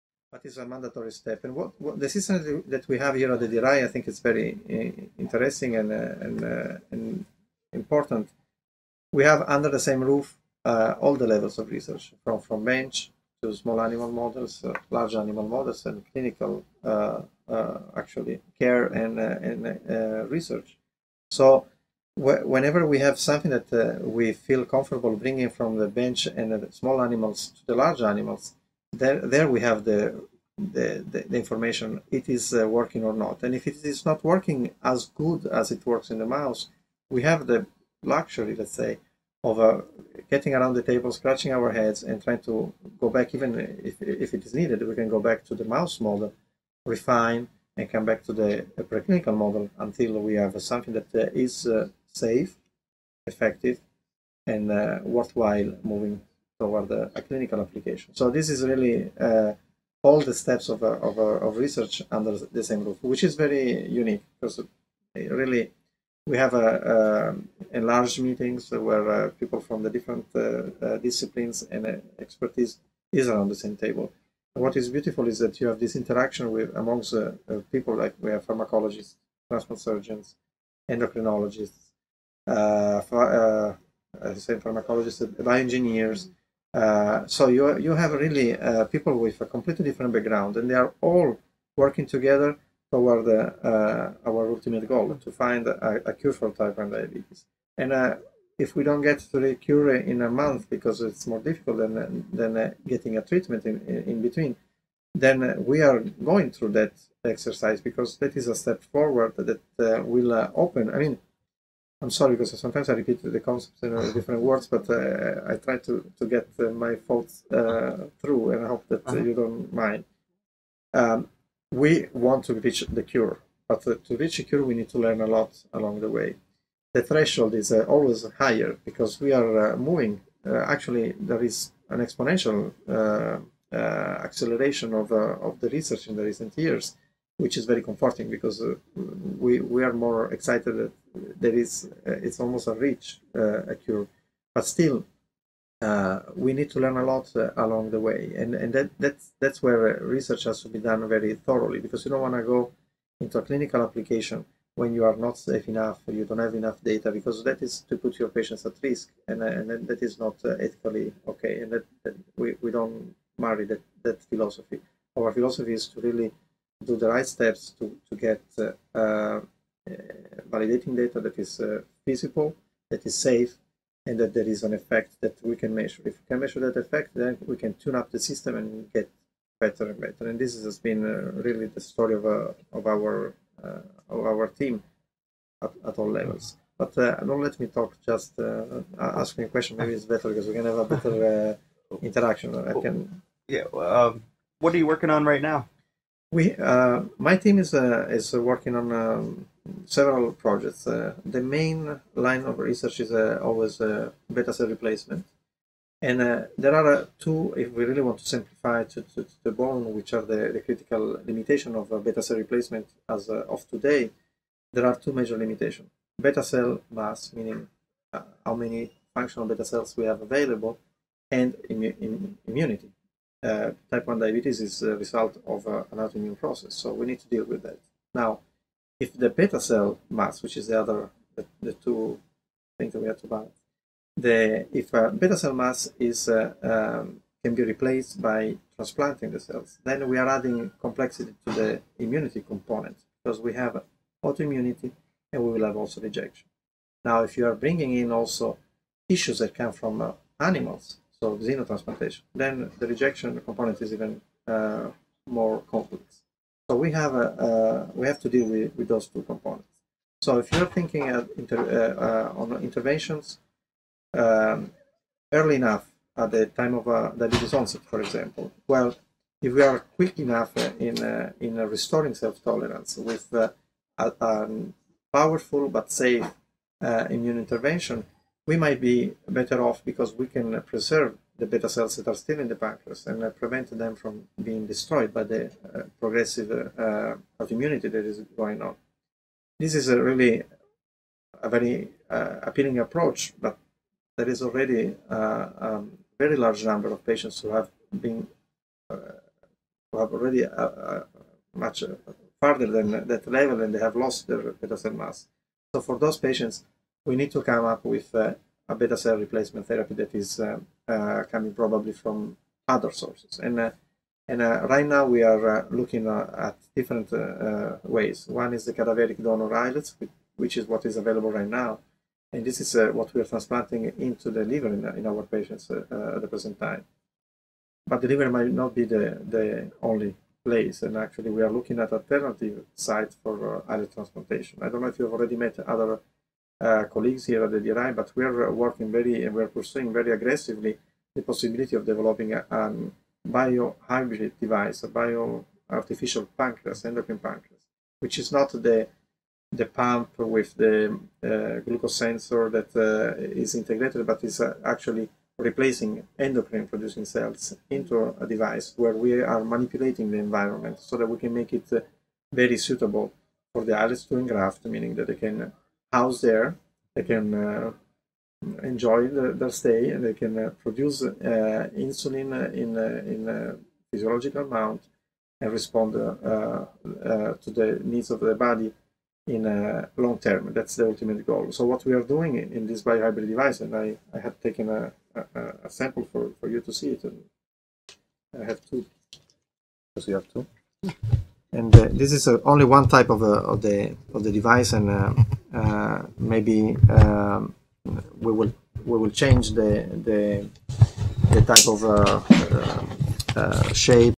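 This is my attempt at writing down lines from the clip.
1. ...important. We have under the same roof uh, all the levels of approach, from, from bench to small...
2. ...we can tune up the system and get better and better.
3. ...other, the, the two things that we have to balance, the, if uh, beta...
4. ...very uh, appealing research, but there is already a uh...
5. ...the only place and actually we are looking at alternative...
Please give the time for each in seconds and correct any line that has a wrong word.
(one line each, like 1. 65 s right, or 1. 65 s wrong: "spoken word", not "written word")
1. 7 s wrong: "research", not "approach"
2. 177 s right
3. 230 s right
4. 291 s wrong: "approach", not "research"
5. 329 s right.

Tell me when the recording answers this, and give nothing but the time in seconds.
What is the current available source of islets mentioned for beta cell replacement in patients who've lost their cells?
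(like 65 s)
318 s.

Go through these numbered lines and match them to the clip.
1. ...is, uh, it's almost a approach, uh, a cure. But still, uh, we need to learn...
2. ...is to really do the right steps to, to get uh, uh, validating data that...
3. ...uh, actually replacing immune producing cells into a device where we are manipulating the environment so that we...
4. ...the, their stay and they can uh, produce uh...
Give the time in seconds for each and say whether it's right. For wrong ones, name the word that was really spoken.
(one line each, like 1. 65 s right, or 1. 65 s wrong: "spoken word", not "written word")
1. 141 s wrong: "reach", not "approach"
2. 165 s right
3. 354 s wrong: "endocrine", not "immune"
4. 369 s right.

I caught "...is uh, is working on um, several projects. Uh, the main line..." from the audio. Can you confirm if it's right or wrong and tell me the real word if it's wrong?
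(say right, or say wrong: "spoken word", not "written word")
right.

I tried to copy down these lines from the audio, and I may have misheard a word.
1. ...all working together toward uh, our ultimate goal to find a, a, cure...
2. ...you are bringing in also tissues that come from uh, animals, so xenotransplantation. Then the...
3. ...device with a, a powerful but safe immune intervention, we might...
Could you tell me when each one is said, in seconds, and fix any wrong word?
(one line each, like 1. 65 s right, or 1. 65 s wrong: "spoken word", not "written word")
1. 91 s right
2. 247 s right
3. 272 s wrong: "tolerance", not "device".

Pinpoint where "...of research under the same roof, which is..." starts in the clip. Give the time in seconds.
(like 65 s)
61 s.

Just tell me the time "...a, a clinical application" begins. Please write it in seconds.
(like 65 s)
56 s.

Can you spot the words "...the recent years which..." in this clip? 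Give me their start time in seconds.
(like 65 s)
136 s.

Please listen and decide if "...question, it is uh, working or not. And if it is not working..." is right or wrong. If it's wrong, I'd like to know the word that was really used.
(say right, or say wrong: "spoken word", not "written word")
wrong: "information", not "question".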